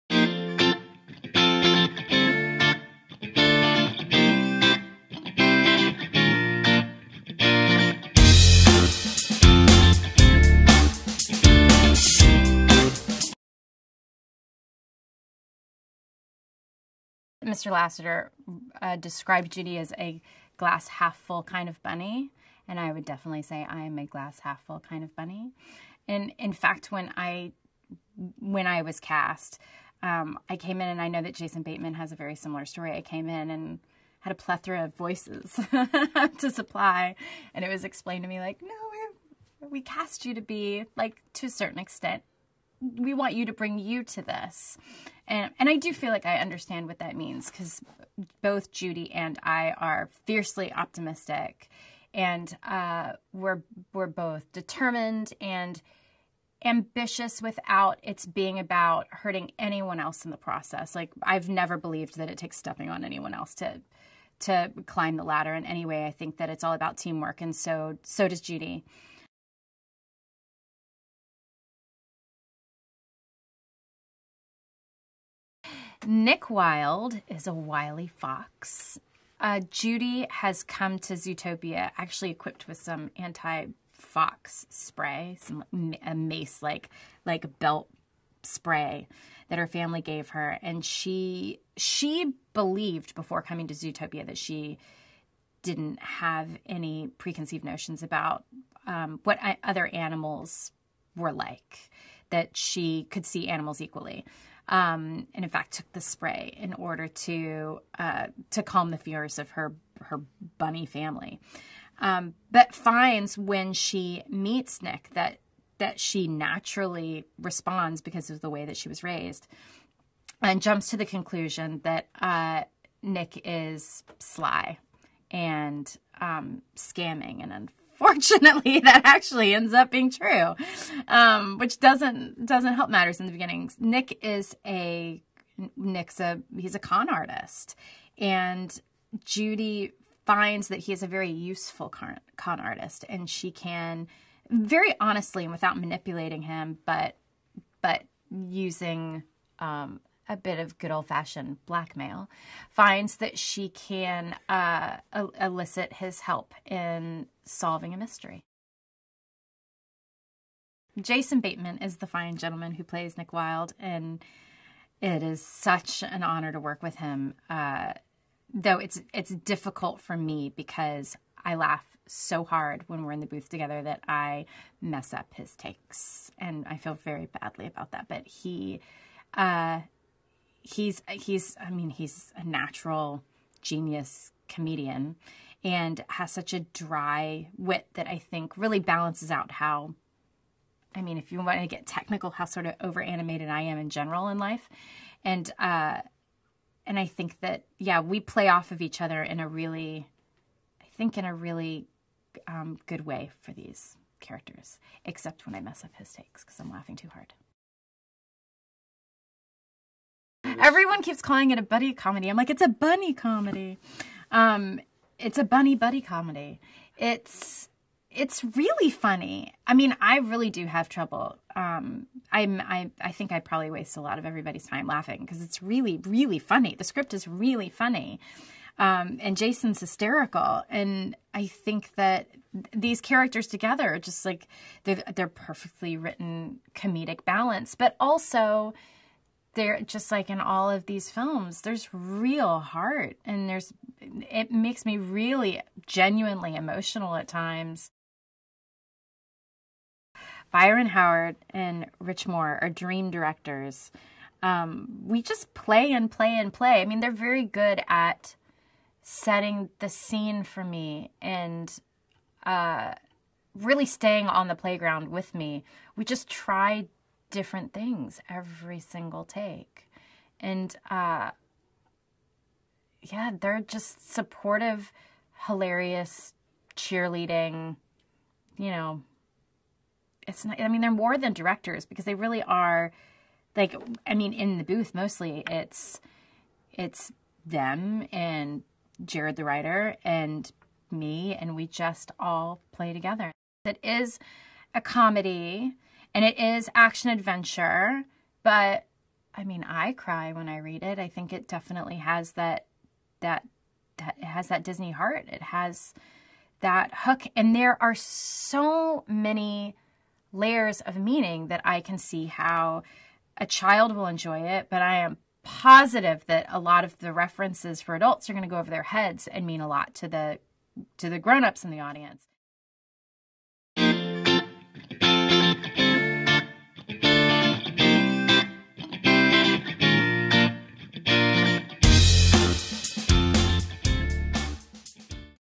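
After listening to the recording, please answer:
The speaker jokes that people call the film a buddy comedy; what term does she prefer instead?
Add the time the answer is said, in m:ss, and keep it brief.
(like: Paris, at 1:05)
bunny comedy, at 3:32.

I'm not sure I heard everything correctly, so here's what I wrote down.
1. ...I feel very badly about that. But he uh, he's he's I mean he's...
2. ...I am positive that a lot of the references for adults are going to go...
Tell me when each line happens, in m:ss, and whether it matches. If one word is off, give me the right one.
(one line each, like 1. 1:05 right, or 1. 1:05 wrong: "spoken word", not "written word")
1. 2:56 right
2. 5:14 right.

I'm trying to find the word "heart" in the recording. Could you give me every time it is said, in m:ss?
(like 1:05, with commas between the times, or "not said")
4:02, 5:04.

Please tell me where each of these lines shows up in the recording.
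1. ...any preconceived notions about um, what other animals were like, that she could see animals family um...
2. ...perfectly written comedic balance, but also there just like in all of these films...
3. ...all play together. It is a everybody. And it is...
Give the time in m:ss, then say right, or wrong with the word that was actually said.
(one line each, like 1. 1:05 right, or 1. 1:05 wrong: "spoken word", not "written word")
1. 1:36 wrong: "equally", not "family"
2. 3:55 right
3. 4:52 wrong: "comedy", not "everybody".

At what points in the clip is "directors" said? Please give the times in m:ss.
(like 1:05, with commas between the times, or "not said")
4:13, 4:41.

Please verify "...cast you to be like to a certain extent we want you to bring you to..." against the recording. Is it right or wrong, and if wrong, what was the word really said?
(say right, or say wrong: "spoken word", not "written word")
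right.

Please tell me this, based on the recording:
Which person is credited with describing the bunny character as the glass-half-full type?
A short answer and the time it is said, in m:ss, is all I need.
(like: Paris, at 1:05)
Mr. Lasseter, at 0:17.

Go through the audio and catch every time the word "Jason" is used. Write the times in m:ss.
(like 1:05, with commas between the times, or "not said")
0:31, 2:40, 3:49.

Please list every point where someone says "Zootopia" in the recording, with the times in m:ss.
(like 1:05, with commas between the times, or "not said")
1:21, 1:33.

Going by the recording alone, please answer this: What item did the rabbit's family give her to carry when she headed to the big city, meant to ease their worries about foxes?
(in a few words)
anti-fox spray.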